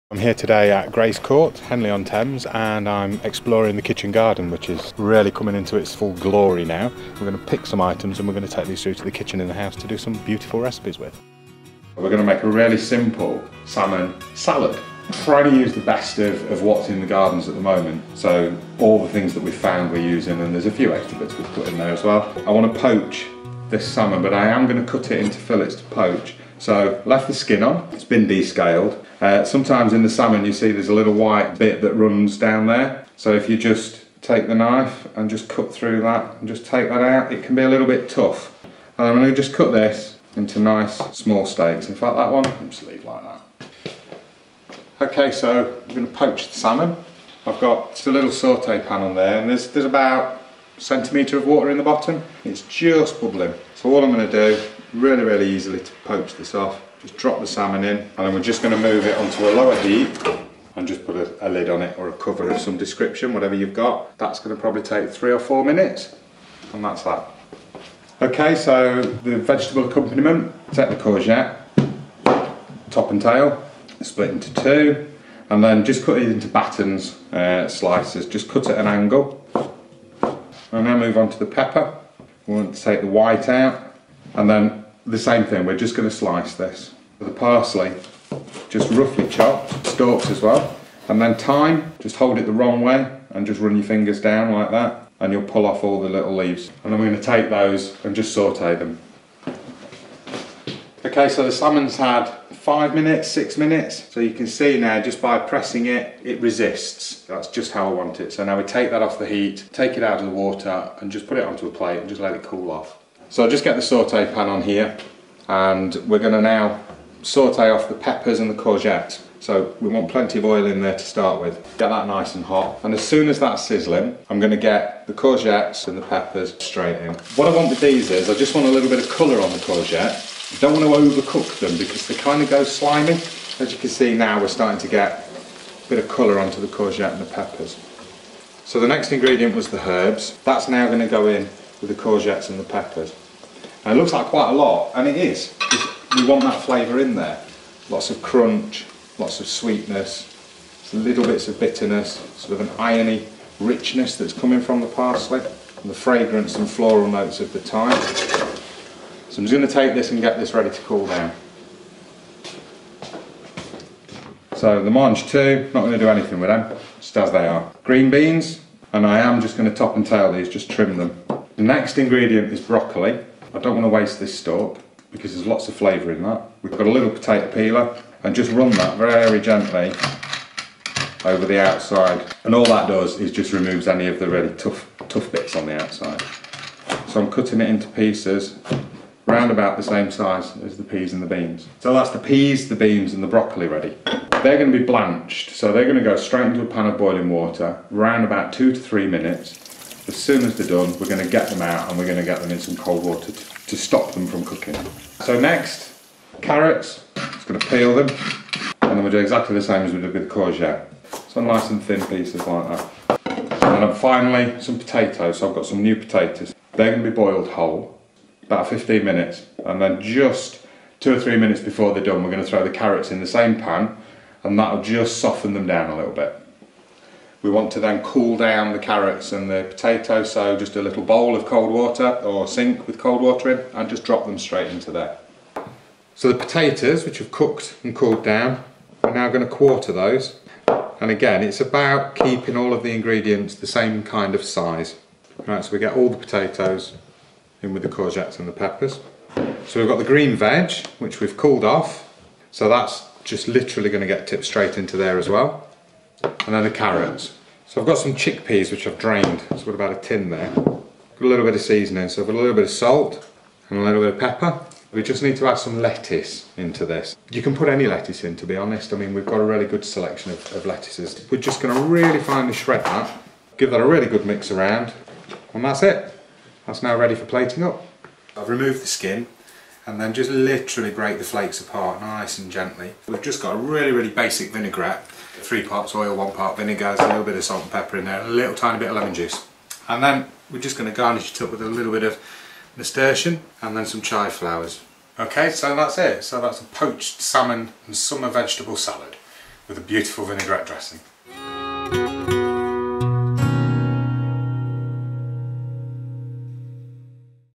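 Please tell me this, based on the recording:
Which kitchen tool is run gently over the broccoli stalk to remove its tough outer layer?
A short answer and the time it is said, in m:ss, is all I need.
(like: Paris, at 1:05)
Potato peeler, at 2:57.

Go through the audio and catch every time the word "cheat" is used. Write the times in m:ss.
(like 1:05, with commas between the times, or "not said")
not said.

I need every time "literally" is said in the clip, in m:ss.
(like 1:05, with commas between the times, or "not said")
4:13, 4:40.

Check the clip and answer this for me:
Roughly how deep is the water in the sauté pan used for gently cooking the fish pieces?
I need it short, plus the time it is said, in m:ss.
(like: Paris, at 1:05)
1 centimetre, at 0:49.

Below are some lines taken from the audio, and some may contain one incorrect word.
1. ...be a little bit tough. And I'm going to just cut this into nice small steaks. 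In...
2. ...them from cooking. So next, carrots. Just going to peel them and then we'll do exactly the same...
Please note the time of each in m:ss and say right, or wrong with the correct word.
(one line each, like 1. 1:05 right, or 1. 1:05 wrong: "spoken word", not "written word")
1. 0:37 right
2. 3:24 right.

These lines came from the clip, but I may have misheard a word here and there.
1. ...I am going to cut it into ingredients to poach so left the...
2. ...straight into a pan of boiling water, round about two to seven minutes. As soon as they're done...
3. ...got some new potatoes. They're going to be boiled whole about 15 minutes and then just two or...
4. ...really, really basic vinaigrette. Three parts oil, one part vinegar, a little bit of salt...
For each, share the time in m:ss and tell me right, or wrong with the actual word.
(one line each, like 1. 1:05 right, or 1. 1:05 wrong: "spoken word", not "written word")
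1. 0:24 wrong: "fillets", not "ingredients"
2. 3:16 wrong: "three", not "seven"
3. 3:35 right
4. 4:43 right.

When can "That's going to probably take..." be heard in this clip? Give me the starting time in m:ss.
1:04.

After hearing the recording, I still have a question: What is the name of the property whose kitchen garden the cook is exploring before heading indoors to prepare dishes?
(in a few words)
Greys Court.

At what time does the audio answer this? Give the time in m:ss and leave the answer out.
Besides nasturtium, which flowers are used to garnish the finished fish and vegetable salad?
4:54.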